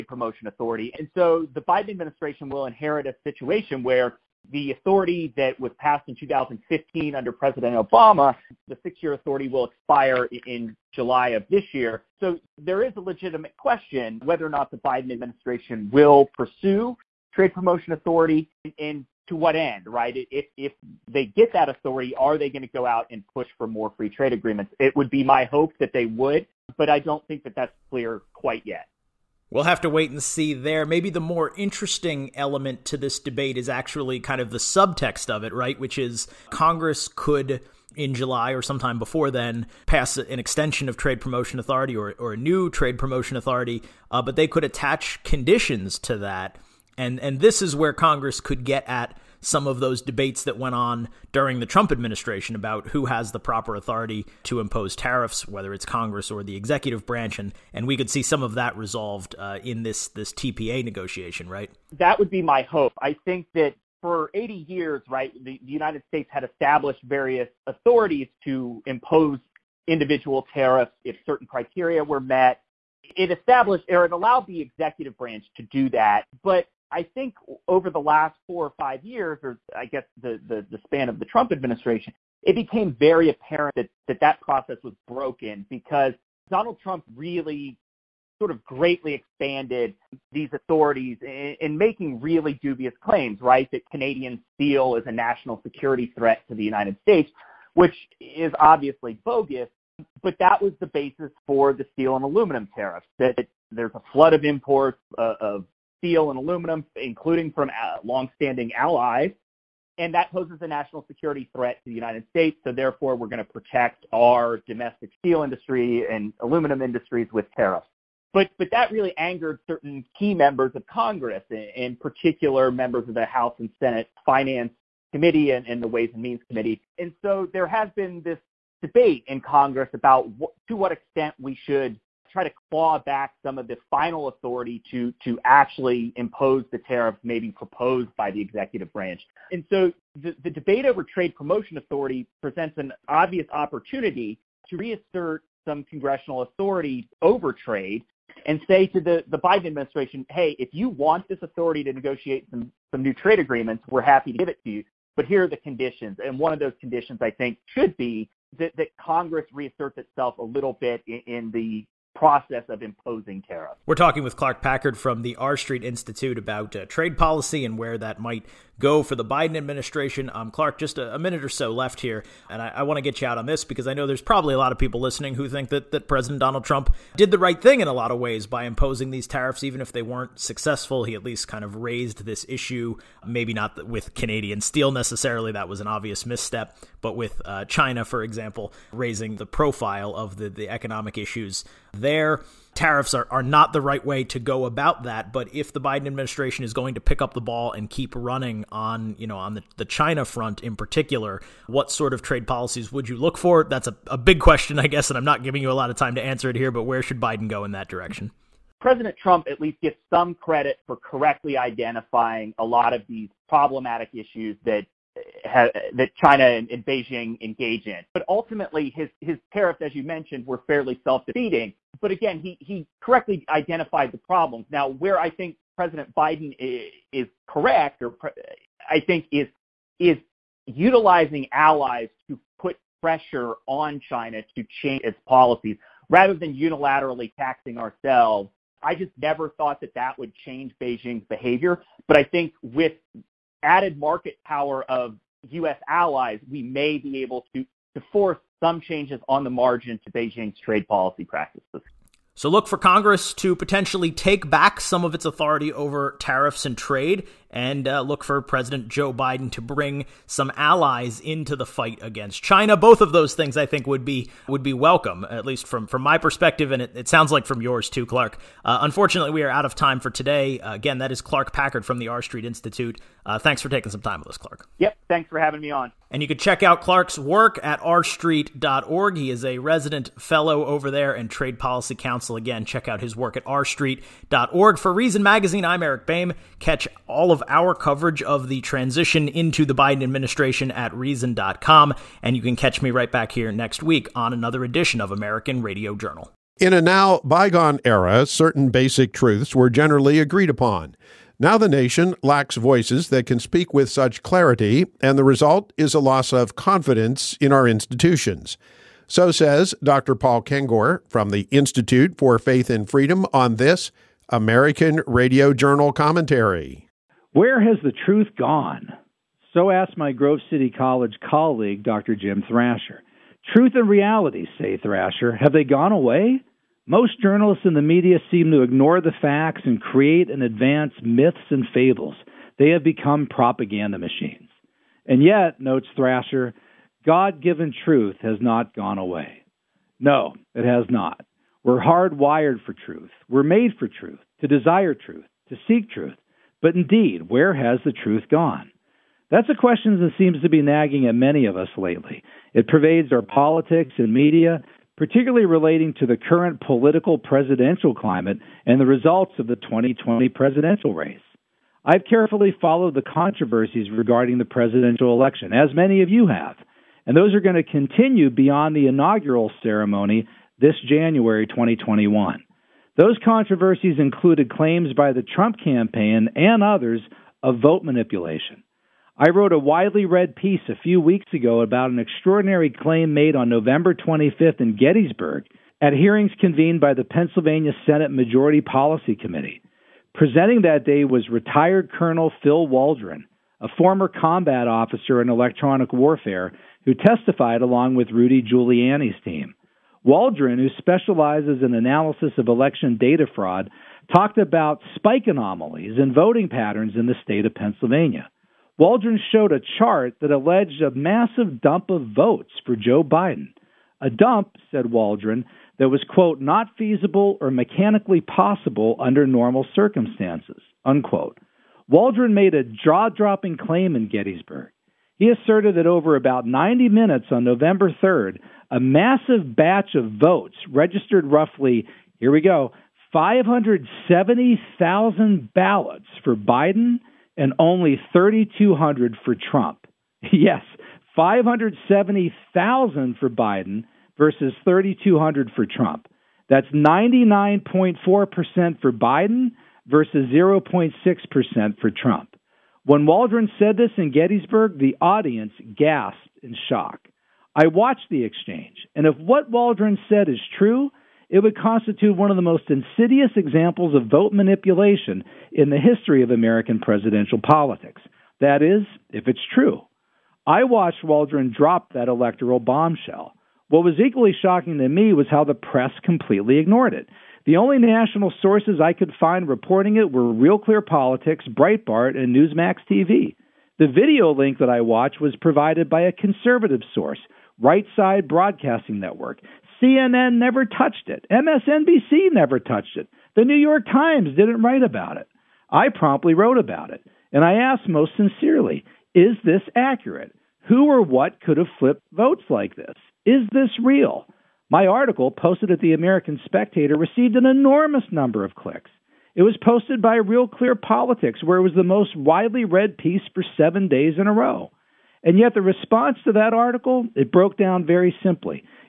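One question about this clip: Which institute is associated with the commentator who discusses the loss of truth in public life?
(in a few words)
Institute for Faith and Freedom.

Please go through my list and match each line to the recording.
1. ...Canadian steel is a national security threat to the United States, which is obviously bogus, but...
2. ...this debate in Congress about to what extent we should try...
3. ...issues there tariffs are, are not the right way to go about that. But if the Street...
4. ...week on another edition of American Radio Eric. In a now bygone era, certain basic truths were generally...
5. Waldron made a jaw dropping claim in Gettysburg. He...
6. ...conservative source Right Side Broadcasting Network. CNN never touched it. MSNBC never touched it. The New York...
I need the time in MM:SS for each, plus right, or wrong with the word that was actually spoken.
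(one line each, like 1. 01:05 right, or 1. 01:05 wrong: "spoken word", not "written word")
1. 01:33 right
2. 02:08 right
3. 03:11 wrong: "Biden", not "Street"
4. 04:53 wrong: "Journal", not "Eric"
5. 07:01 right
6. 08:06 right.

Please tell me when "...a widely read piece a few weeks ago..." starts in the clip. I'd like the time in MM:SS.
06:19.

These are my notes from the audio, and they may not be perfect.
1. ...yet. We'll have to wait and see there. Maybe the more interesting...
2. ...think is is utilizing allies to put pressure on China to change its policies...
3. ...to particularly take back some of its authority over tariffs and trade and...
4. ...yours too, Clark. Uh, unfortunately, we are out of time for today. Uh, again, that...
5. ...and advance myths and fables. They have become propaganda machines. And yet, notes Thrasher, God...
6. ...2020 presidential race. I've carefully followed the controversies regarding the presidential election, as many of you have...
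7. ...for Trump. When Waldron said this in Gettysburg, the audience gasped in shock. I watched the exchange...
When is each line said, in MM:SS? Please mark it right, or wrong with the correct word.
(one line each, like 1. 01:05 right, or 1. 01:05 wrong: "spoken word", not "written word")
1. 00:28 right
2. 03:49 right
3. 04:13 wrong: "potentially", not "particularly"
4. 04:27 right
5. 05:30 right
6. 05:59 right
7. 07:31 right.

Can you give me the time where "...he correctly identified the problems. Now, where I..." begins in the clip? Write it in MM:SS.
03:42.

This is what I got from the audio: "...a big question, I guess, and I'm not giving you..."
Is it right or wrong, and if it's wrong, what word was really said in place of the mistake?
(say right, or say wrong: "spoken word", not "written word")
right.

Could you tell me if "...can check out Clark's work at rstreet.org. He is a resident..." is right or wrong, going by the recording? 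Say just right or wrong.
right.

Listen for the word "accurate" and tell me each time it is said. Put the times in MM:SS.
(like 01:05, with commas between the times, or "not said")
08:19.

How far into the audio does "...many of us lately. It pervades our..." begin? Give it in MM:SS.
05:51.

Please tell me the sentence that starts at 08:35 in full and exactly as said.
And yet, the response to that article, it broke down very simply.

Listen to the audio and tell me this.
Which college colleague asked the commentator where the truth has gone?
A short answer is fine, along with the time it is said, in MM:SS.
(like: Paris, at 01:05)
Jim Thrasher, at 05:22.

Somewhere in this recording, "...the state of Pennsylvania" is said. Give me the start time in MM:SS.
06:47.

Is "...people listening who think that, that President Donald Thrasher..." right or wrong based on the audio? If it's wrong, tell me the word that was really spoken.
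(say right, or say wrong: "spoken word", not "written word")
wrong: "Trump", not "Thrasher".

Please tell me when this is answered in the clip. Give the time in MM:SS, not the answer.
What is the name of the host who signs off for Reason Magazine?
04:45.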